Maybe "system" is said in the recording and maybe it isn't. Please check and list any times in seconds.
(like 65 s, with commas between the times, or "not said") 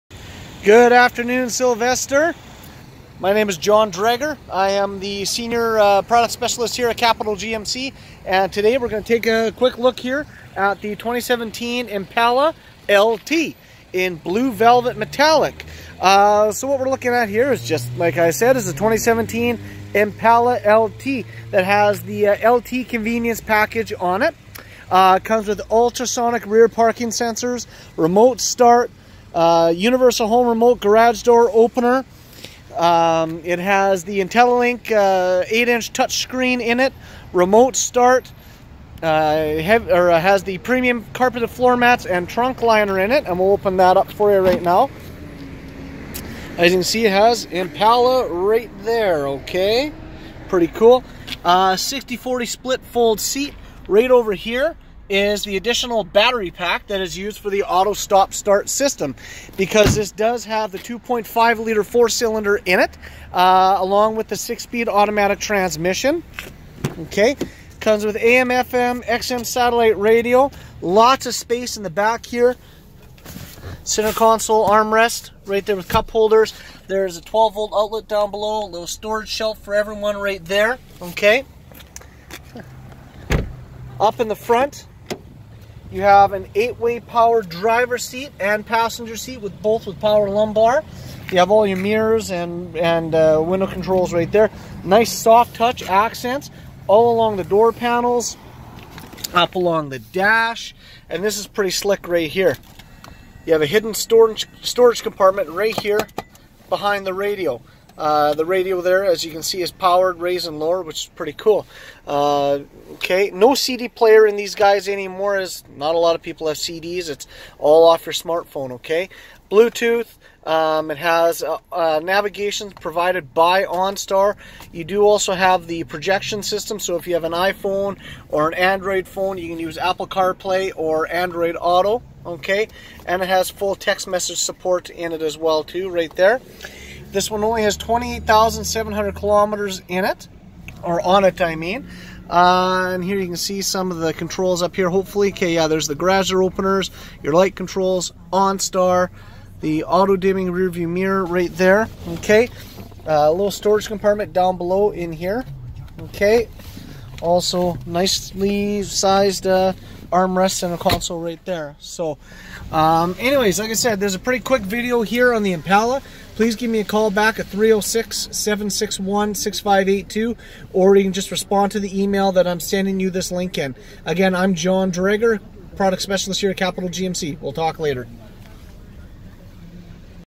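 58 s, 126 s.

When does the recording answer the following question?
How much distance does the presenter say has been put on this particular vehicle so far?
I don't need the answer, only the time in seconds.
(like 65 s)
137 s.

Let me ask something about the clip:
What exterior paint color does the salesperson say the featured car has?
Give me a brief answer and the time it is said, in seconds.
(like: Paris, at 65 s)
Blue velvet metallic, at 14 s.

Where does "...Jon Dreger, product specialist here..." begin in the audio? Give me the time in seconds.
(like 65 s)
174 s.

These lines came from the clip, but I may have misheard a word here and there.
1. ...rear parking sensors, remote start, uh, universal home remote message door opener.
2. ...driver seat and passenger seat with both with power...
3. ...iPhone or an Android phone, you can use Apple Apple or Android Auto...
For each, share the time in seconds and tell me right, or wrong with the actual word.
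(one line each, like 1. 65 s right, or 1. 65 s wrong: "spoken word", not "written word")
1. 26 s wrong: "garage", not "message"
2. 87 s right
3. 127 s wrong: "CarPlay", not "Apple".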